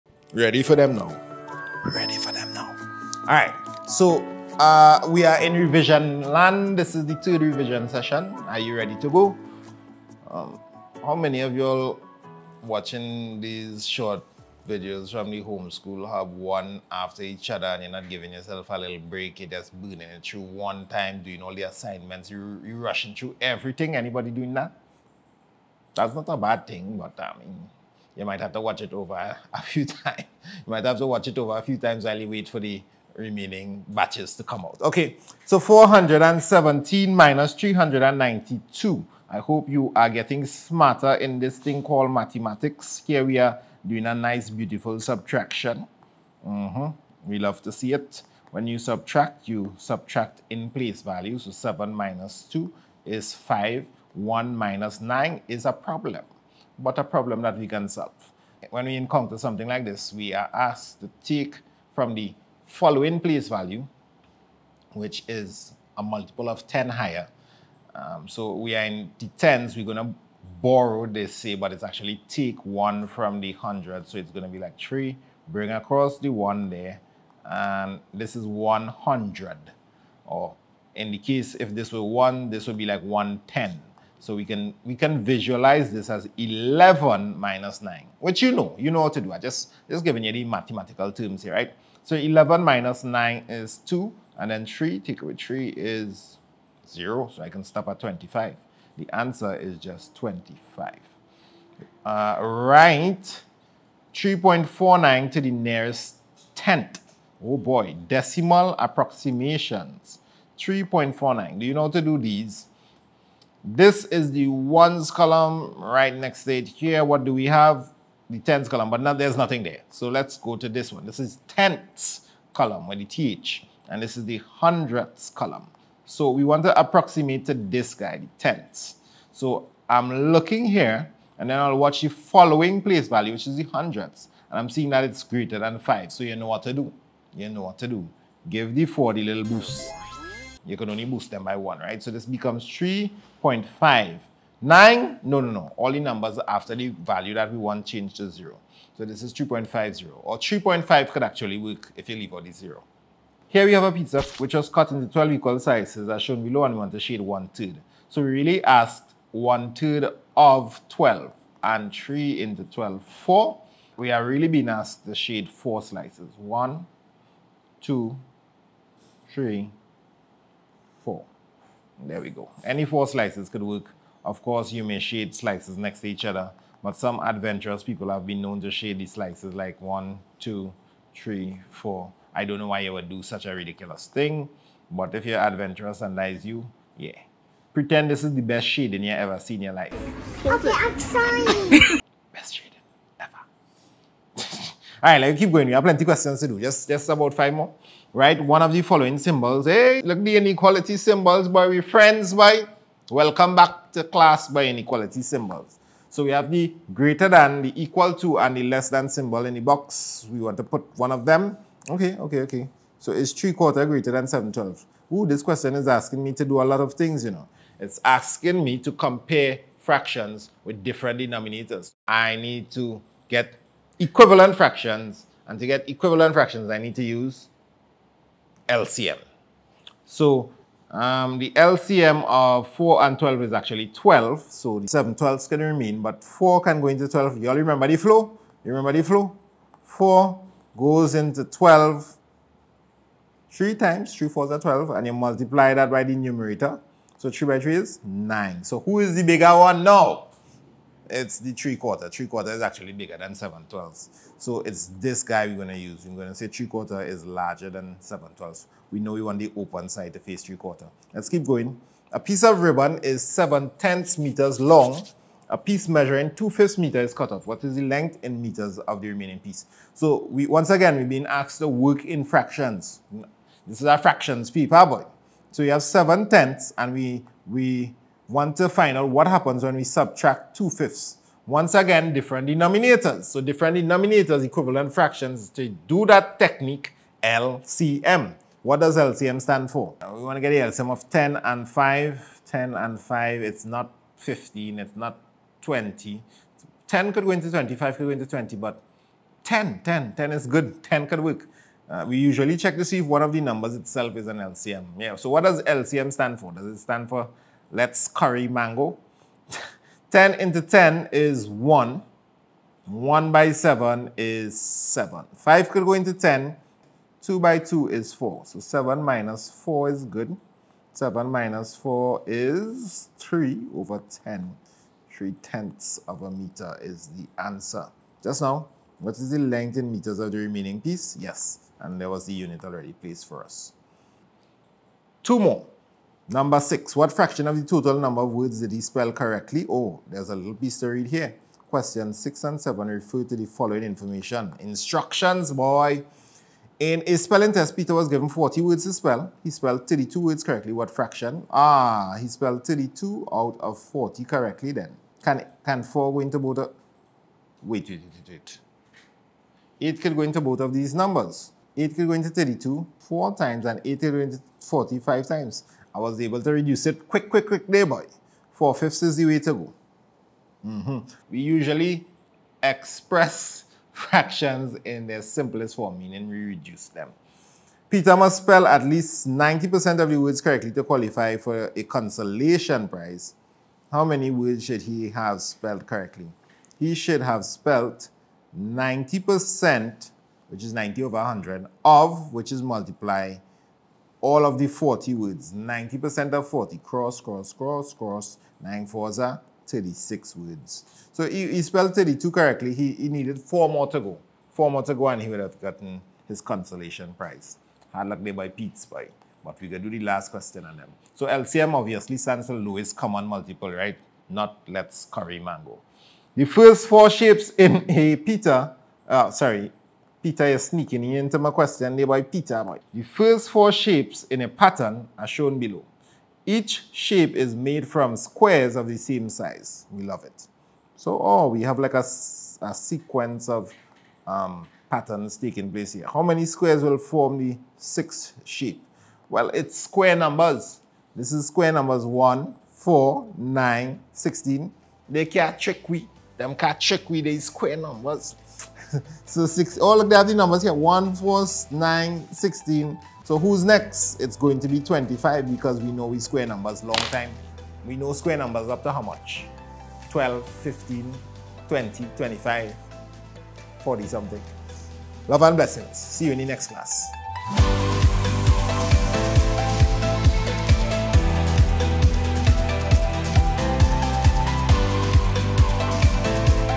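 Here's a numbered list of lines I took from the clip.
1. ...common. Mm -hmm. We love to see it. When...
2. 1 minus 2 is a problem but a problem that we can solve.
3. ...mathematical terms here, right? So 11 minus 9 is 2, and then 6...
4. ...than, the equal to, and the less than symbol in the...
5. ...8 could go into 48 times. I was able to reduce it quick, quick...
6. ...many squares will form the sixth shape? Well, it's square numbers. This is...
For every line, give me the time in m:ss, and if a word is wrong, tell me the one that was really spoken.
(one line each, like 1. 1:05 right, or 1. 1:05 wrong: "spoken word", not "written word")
1. 0:44 wrong: "subtraction", not "common"
2. 0:54 wrong: "9", not "2"
3. 1:30 wrong: "3", not "6"
4. 3:27 right
5. 6:03 wrong: "45", not "48"
6. 7:16 right.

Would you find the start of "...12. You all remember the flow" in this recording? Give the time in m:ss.
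3:57.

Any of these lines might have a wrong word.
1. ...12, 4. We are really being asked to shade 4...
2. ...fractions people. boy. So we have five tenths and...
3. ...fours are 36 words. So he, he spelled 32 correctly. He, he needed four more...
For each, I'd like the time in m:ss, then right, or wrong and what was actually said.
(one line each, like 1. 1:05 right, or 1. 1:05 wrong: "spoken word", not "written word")
1. 2:42 right
2. 4:33 wrong: "seven", not "five"
3. 6:38 right.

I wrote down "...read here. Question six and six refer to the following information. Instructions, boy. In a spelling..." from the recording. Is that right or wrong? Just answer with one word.
wrong.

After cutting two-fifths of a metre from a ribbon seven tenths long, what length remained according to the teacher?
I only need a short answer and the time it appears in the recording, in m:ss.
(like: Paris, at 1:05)
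3/10 of a meter, at 5:25.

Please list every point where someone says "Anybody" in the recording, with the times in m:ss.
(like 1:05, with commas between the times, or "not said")
0:23.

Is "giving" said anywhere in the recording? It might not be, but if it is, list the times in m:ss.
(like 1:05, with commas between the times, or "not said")
0:18, 1:30.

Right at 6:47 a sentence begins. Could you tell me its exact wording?
Hard luck there by Pete's Spy.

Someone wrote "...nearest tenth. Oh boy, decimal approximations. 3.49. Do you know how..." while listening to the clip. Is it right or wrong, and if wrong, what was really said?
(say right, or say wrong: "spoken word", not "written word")
right.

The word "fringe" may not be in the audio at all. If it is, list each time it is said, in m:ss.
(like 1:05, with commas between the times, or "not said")
not said.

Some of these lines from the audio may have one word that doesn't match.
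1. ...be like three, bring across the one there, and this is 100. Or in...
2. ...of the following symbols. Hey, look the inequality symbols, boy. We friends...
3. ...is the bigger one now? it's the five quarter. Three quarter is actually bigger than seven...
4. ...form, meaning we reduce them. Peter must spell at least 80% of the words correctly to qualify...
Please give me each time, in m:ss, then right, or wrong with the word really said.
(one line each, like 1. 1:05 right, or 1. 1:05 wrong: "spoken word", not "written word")
1. 1:14 right
2. 3:18 right
3. 4:08 wrong: "three", not "five"
4. 6:15 wrong: "90", not "80".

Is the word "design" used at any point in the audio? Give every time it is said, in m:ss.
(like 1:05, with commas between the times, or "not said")
not said.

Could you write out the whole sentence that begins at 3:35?
Ooh, this question is asking me to do a lot of things, you know.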